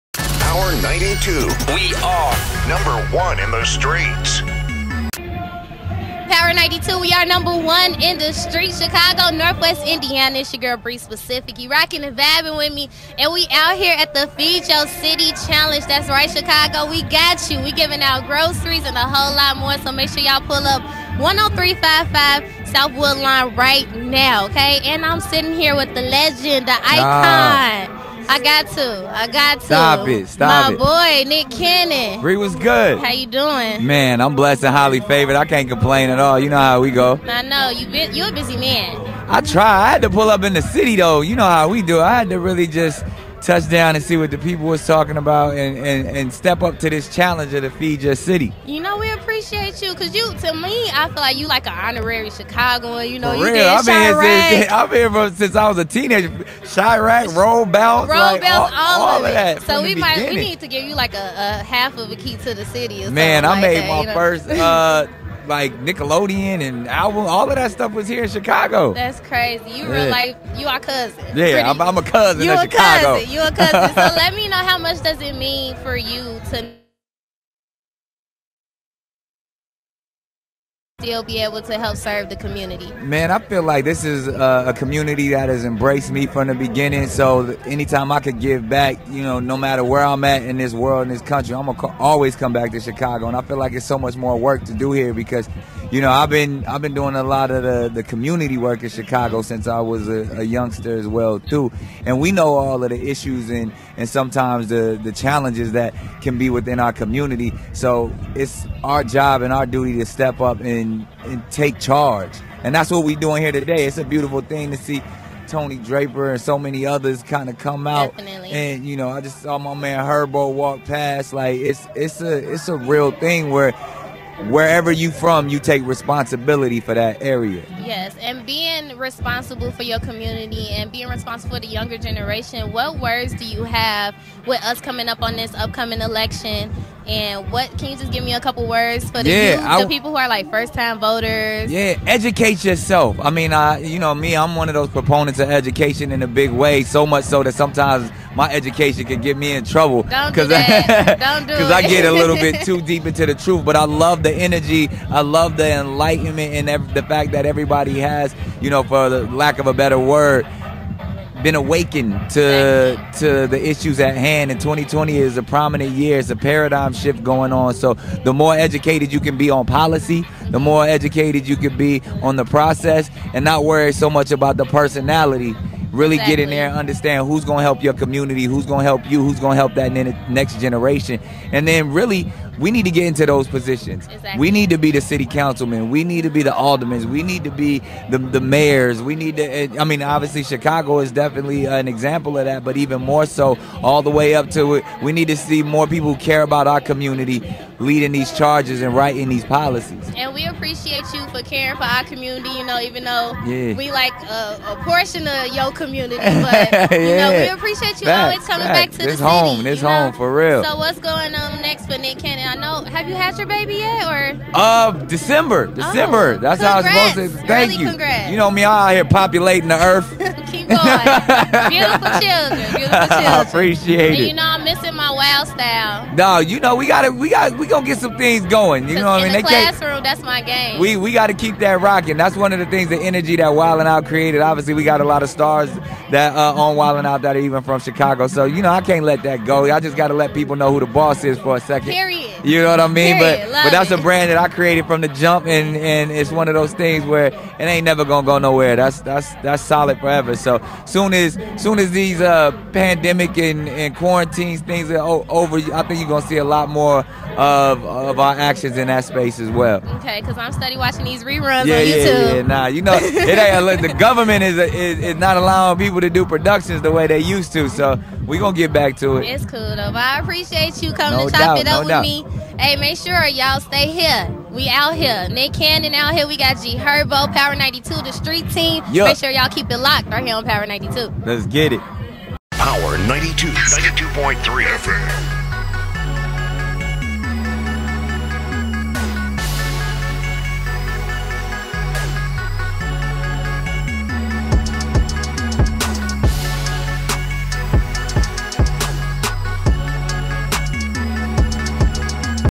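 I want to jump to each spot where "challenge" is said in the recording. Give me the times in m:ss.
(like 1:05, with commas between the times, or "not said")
0:15, 0:47, 1:45.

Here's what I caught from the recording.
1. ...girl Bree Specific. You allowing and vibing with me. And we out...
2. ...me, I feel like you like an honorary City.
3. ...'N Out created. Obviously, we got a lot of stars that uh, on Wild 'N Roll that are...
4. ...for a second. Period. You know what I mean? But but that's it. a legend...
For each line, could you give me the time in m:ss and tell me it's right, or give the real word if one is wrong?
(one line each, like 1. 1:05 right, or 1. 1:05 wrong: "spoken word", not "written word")
1. 0:10 wrong: "rocking", not "allowing"
2. 0:50 wrong: "Chicagoan", not "City"
3. 3:53 wrong: "Out", not "Roll"
4. 4:01 wrong: "brand", not "legend".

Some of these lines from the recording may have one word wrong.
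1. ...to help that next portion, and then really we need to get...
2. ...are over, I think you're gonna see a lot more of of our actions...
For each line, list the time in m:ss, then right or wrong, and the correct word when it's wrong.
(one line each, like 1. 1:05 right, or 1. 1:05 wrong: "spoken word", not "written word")
1. 2:59 wrong: "generation", not "portion"
2. 4:14 right.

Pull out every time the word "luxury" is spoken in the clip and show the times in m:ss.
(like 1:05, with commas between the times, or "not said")
not said.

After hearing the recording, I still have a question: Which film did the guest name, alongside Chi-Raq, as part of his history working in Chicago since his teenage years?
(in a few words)
Roll Bounce.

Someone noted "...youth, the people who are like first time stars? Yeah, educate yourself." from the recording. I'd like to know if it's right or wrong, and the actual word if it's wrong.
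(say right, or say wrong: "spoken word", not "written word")
wrong: "voters", not "stars".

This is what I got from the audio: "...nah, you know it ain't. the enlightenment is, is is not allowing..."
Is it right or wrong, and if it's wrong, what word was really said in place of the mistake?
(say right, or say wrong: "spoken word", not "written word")
wrong: "government", not "enlightenment".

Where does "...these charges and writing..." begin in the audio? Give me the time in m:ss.
3:18.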